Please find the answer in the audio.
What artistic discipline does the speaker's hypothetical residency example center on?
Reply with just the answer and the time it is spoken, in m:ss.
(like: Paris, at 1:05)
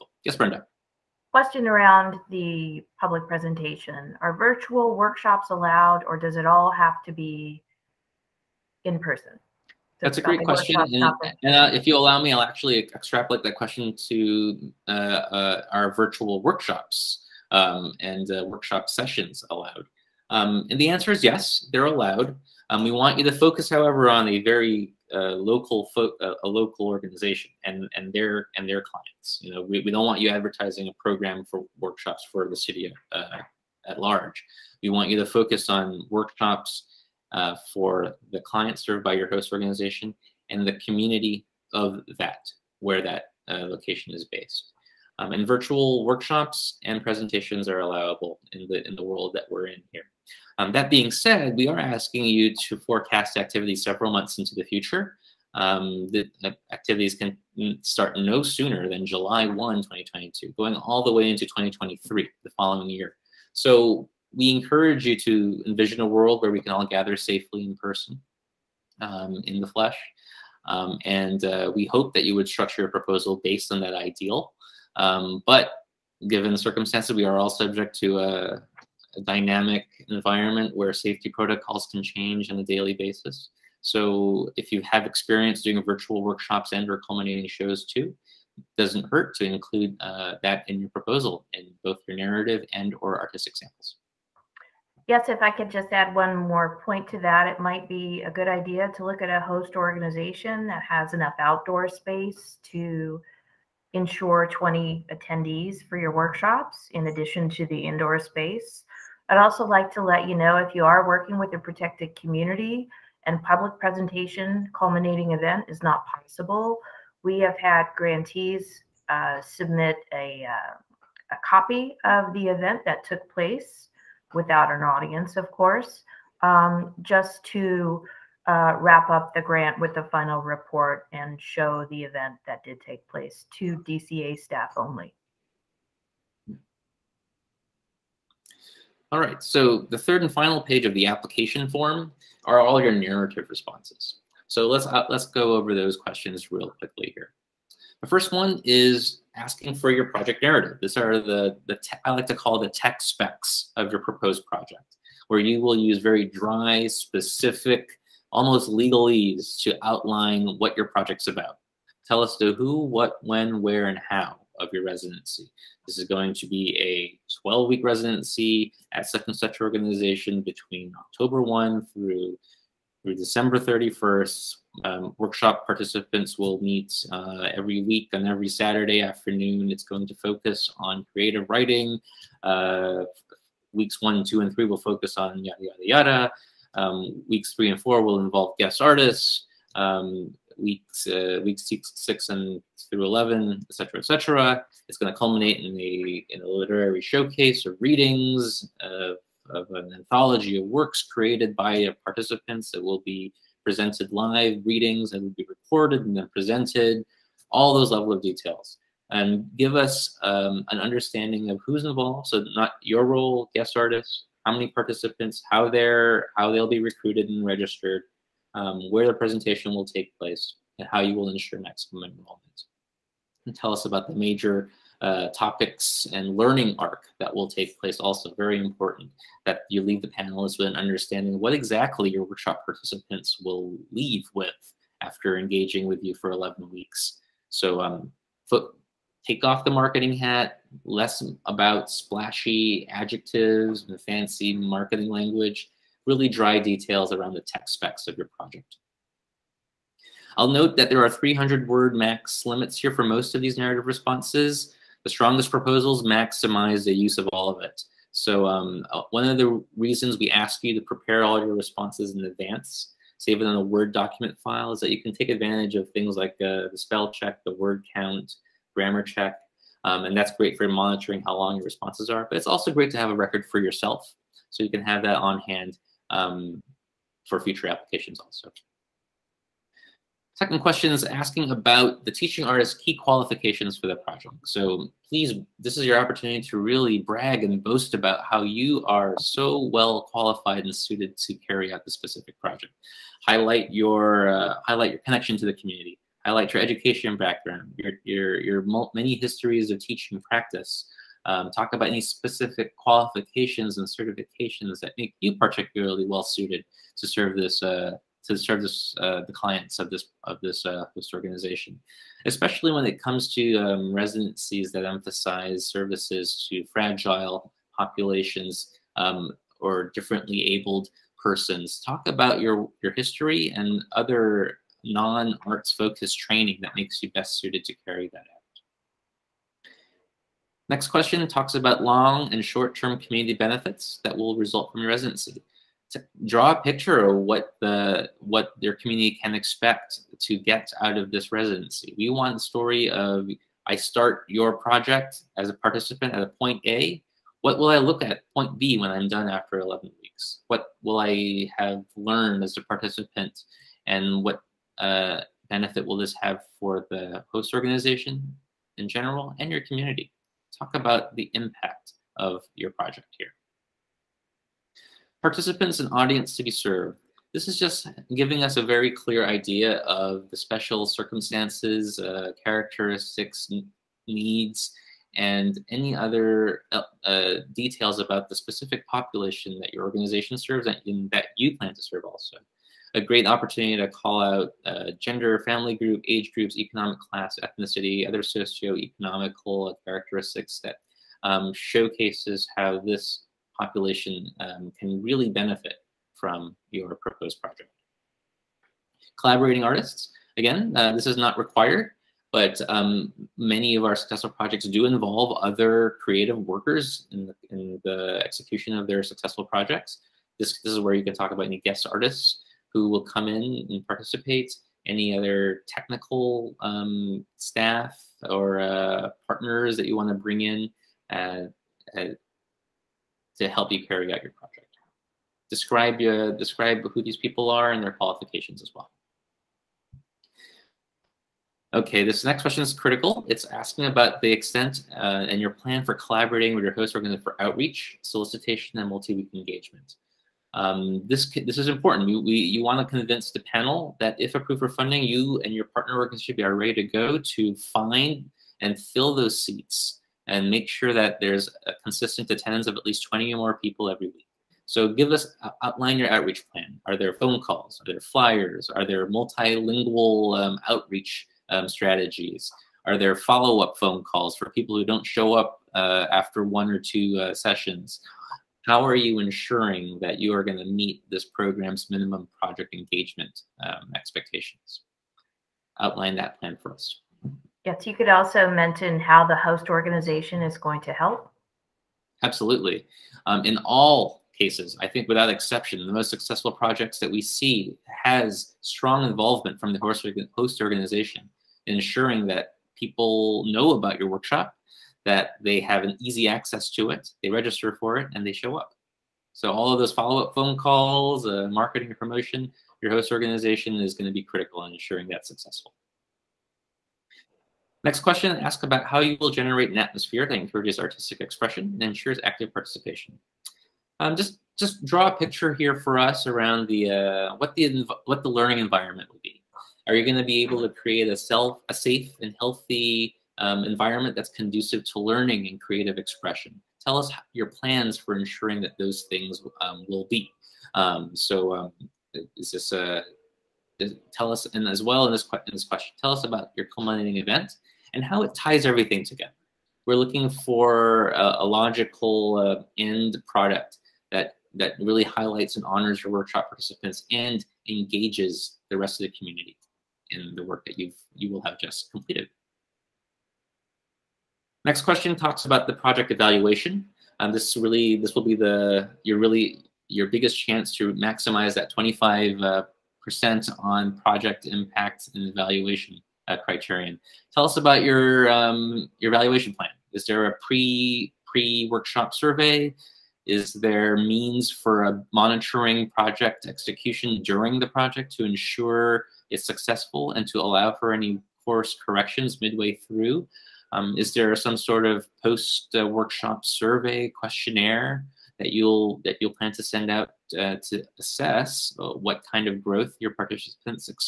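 creative writing, at 3:01.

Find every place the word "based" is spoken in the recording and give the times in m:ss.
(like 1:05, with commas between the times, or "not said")
0:44, 1:13.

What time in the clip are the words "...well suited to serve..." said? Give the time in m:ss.
5:06.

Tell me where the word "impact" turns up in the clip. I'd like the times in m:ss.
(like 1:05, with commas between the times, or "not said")
6:01, 9:24.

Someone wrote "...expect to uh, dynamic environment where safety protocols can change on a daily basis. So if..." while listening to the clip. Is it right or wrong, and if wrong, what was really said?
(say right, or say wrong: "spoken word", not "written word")
wrong: "subject", not "expect".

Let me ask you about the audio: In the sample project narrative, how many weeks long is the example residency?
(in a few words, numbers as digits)
12.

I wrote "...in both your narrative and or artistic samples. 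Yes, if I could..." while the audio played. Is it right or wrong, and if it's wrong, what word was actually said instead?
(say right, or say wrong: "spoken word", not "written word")
right.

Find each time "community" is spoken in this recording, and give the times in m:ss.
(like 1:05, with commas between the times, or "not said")
0:40, 1:52, 4:55, 5:33, 5:38, 5:59, 9:09.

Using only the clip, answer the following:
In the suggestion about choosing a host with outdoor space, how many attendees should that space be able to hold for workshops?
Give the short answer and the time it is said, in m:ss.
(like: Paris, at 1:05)
20, at 1:44.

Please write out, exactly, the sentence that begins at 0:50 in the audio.
Um, that being said, we are asking you to forecast activity several months into the future.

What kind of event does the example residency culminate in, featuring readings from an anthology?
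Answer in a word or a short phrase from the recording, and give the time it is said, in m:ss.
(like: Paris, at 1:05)
literary showcase, at 3:16.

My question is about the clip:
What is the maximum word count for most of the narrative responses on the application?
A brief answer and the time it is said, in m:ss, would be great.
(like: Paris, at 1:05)
300, at 4:11.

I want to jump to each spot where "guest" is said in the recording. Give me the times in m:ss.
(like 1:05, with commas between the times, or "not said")
3:08, 3:33, 6:51.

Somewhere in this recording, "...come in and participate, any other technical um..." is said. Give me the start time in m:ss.
6:53.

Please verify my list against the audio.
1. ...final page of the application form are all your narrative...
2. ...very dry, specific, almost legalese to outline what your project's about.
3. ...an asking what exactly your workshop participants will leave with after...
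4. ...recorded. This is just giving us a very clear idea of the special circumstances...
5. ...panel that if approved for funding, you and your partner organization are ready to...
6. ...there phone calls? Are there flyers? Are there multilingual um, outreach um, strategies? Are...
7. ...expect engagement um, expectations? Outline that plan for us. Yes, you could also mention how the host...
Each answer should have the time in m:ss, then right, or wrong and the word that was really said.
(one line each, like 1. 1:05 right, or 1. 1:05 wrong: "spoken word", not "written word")
1. 2:20 right
2. 2:35 right
3. 3:50 wrong: "understanding", not "asking"
4. 6:06 wrong: "served", not "recorded"
5. 7:23 right
6. 7:36 right
7. 7:52 wrong: "project", not "expect".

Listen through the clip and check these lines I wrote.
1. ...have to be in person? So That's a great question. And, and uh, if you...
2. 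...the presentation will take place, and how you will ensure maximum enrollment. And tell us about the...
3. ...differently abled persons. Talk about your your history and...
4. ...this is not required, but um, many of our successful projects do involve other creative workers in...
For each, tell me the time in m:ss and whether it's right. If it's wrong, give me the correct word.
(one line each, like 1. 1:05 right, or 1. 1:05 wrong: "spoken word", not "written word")
1. 0:06 right
2. 3:39 right
3. 5:19 right
4. 6:40 right.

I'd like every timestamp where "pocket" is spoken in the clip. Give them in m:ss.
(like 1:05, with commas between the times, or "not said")
not said.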